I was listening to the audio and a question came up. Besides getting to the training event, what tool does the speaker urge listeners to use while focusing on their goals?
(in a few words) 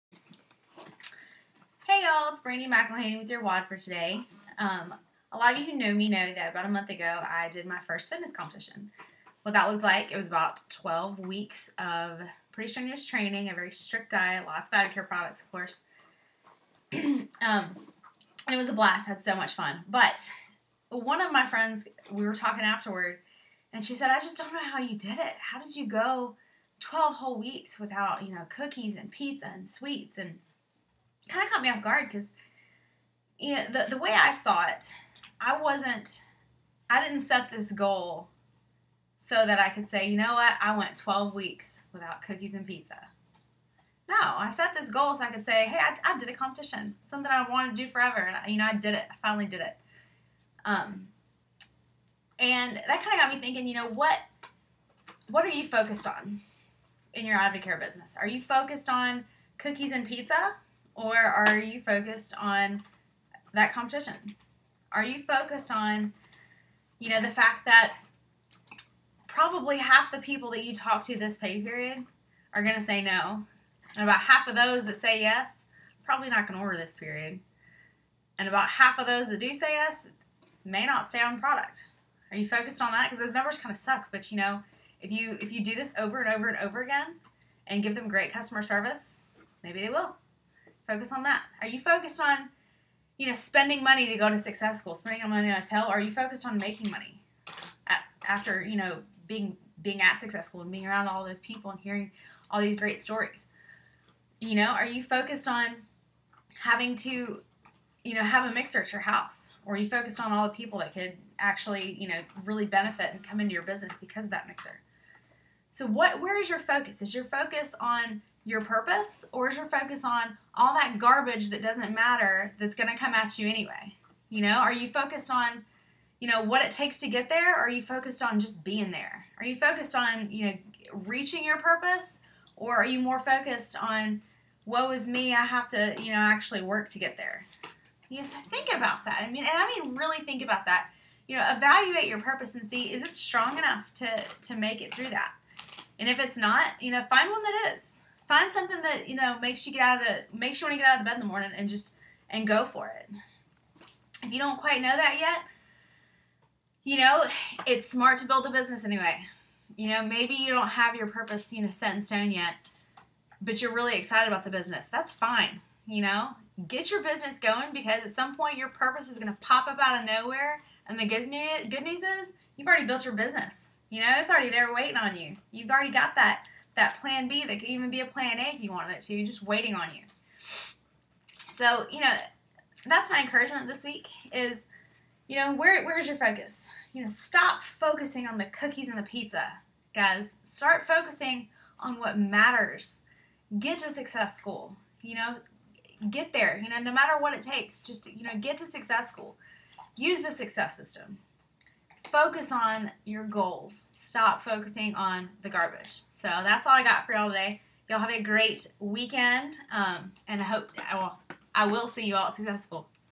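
success system.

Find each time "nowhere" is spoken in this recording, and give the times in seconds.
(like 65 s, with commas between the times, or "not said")
170 s.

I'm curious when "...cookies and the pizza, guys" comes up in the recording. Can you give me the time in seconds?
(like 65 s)
188 s.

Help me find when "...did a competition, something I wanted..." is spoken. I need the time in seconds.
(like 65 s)
46 s.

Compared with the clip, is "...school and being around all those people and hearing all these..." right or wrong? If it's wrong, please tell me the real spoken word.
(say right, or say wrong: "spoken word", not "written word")
right.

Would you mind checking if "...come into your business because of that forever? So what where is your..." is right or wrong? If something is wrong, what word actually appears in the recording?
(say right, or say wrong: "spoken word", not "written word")
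wrong: "mixer", not "forever".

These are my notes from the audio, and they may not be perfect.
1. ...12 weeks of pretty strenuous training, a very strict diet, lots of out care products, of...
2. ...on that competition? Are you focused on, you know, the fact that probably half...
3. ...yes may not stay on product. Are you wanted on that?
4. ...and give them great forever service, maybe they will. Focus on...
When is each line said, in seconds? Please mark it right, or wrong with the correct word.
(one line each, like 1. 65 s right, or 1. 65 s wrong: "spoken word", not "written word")
1. 10 s right
2. 62 s right
3. 79 s wrong: "focused", not "wanted"
4. 87 s wrong: "customer", not "forever".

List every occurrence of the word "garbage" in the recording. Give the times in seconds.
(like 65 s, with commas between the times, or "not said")
120 s, 205 s.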